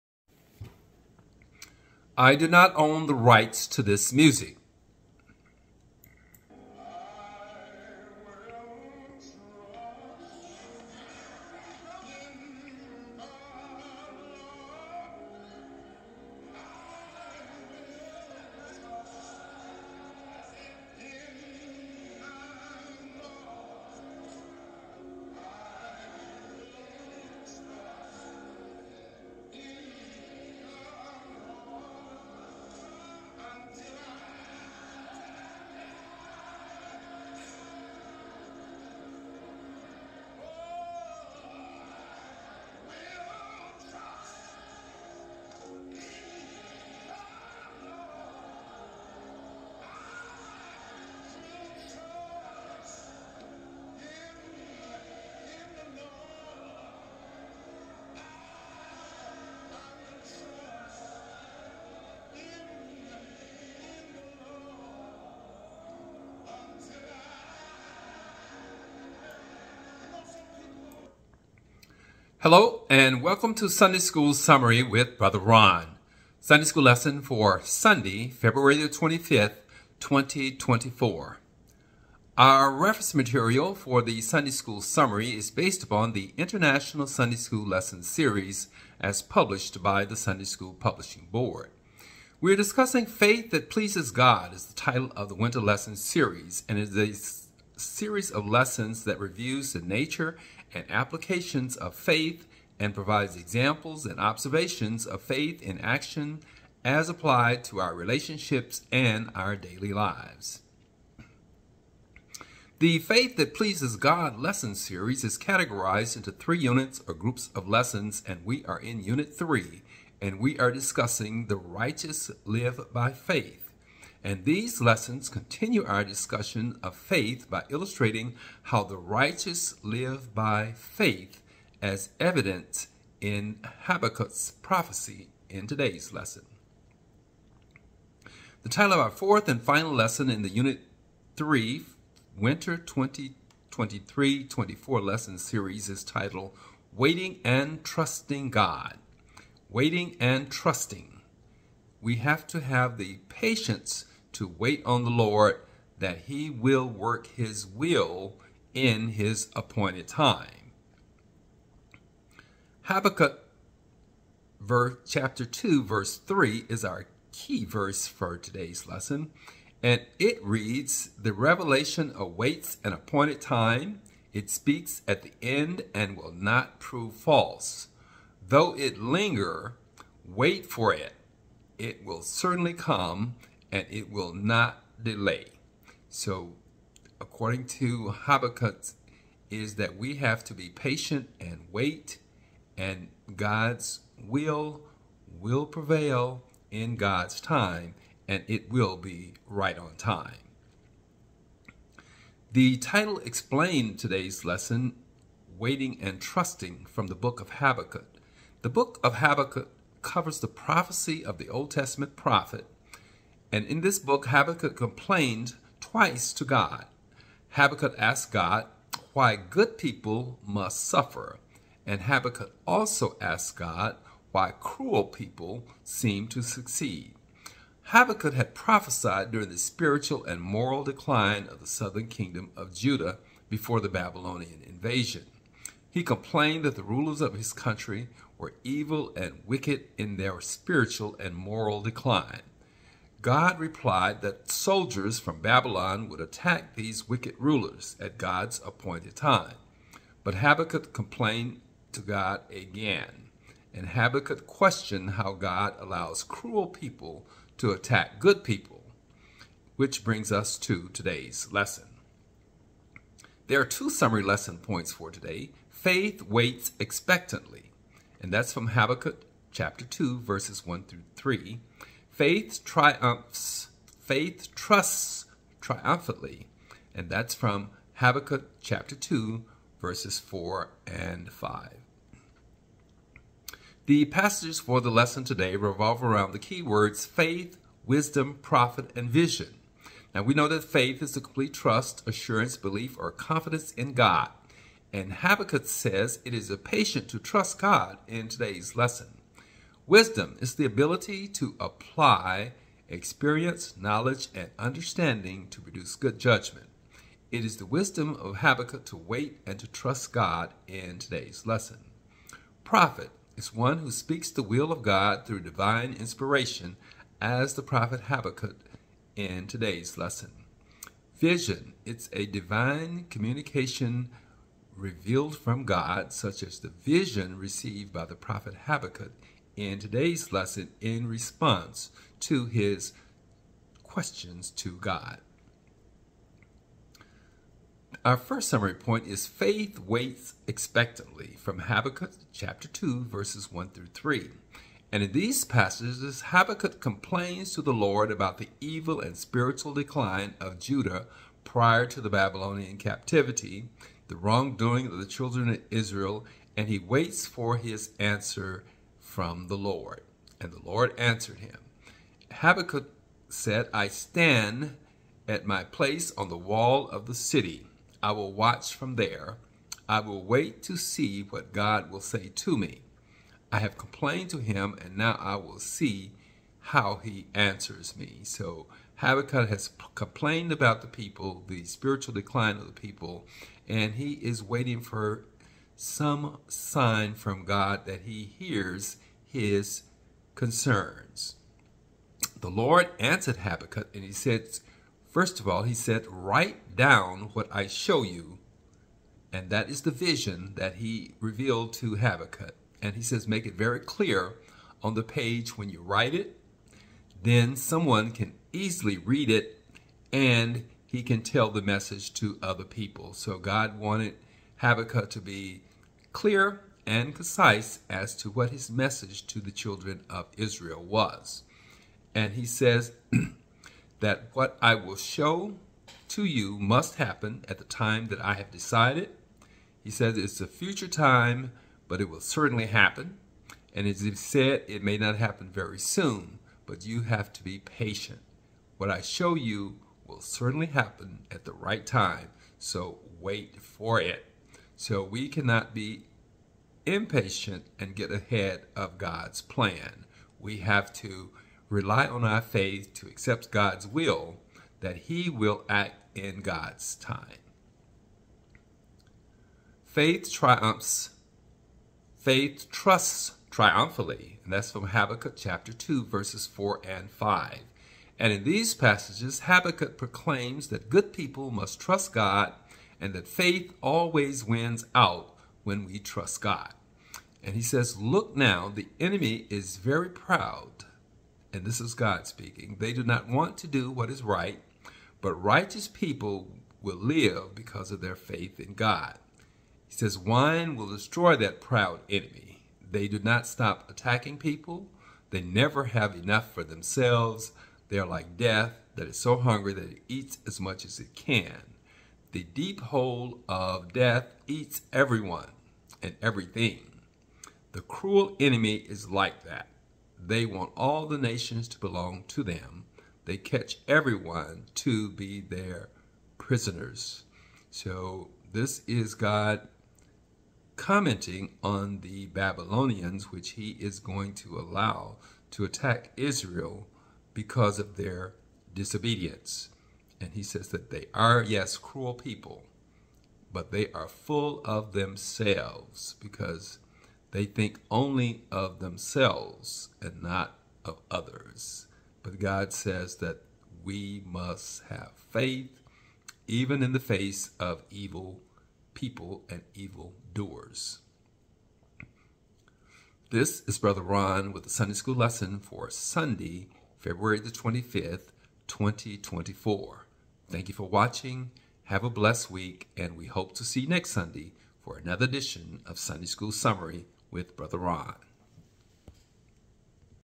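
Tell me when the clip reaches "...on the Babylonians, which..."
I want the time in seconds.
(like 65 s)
521 s.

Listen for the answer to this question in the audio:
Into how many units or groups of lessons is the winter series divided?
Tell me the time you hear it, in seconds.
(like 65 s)
116 s.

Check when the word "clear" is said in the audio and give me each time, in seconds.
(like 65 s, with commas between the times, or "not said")
403 s, 416 s.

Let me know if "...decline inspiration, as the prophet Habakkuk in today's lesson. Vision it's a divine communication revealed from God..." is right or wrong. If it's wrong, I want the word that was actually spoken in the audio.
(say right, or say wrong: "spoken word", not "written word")
wrong: "divine", not "decline".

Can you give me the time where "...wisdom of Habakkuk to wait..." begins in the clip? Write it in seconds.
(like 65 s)
307 s.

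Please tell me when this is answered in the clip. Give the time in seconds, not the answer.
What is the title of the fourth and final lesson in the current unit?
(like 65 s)
146 s.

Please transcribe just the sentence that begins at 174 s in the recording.
It speaks at the end and will not prove false.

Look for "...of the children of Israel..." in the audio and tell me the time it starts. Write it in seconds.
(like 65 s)
354 s.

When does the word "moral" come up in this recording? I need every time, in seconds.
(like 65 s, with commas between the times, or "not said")
230 s, 241 s.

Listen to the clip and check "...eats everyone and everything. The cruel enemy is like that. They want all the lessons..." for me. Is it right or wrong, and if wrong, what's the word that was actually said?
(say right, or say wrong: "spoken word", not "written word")
wrong: "nations", not "lessons".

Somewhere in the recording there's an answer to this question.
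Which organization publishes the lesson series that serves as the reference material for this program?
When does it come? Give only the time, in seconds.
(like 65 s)
90 s.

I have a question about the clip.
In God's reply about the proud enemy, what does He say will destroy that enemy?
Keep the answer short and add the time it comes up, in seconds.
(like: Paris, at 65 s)
Wine, at 490 s.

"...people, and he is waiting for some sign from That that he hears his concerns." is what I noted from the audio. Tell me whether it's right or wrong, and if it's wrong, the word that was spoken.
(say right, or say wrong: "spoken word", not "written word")
wrong: "God", not "That".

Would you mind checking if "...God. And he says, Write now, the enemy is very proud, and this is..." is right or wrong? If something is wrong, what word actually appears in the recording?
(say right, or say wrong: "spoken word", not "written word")
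wrong: "Look", not "Write".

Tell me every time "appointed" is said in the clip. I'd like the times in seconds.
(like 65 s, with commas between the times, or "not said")
159 s, 172 s, 248 s.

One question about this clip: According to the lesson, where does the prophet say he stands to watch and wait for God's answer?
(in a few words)
On the wall of the city.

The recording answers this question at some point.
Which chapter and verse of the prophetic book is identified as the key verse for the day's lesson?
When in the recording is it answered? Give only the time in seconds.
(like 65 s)
165 s.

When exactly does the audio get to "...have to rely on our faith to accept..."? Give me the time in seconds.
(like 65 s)
450 s.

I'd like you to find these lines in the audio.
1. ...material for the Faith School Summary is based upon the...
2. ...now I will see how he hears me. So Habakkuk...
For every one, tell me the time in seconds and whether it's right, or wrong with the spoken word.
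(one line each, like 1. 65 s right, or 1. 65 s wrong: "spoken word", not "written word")
1. 83 s wrong: "Sunday", not "Faith"
2. 374 s wrong: "answers", not "hears".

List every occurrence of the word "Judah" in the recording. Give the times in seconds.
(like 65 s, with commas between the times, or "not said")
232 s, 350 s.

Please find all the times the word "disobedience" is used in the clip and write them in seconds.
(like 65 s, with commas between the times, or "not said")
528 s.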